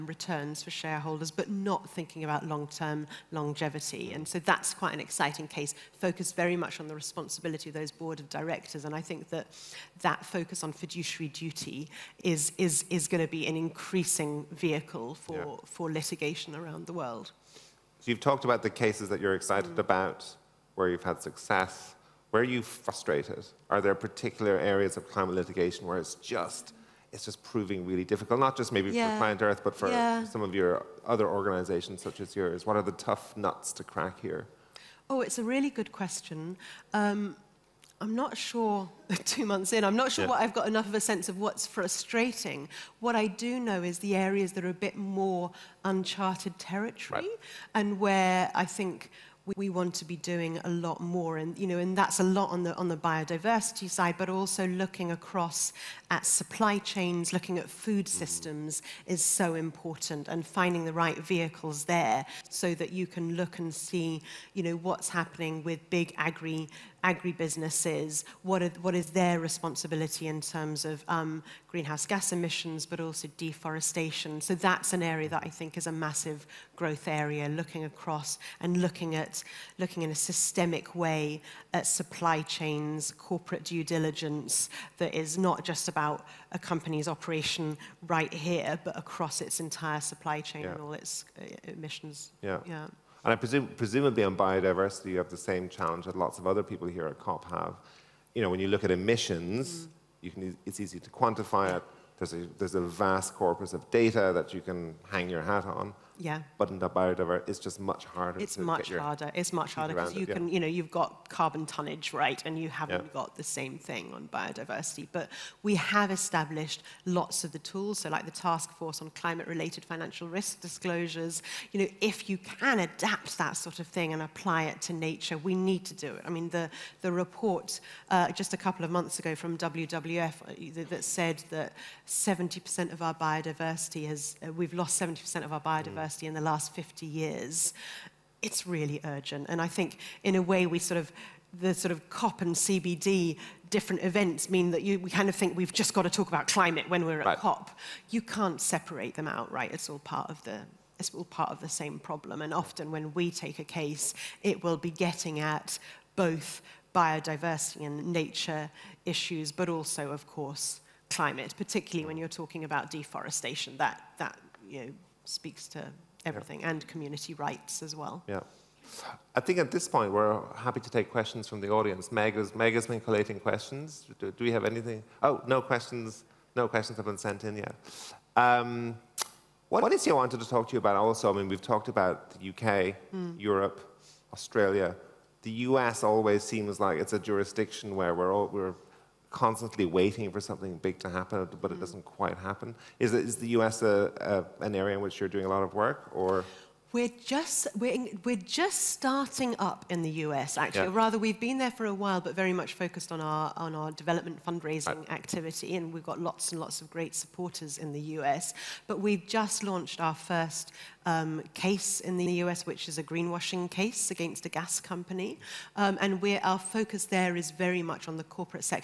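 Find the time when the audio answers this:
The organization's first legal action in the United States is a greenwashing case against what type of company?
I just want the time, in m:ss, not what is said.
3:34.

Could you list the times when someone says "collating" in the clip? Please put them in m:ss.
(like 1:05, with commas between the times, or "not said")
2:52.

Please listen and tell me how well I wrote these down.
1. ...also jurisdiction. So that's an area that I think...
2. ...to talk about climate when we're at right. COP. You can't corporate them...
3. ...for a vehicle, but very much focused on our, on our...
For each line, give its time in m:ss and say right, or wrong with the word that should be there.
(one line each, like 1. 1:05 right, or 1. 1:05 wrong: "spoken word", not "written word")
1. 1:12 wrong: "deforestation", not "jurisdiction"
2. 2:26 wrong: "separate", not "corporate"
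3. 3:21 wrong: "while", not "vehicle".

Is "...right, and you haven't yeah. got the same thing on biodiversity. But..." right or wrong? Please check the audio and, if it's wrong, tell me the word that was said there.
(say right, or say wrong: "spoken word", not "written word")
right.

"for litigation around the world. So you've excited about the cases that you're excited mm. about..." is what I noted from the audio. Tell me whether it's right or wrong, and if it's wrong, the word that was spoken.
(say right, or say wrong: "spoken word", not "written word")
wrong: "talked", not "excited".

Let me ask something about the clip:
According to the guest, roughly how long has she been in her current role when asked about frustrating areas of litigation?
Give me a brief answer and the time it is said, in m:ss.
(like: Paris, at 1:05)
2 months, at 0:39.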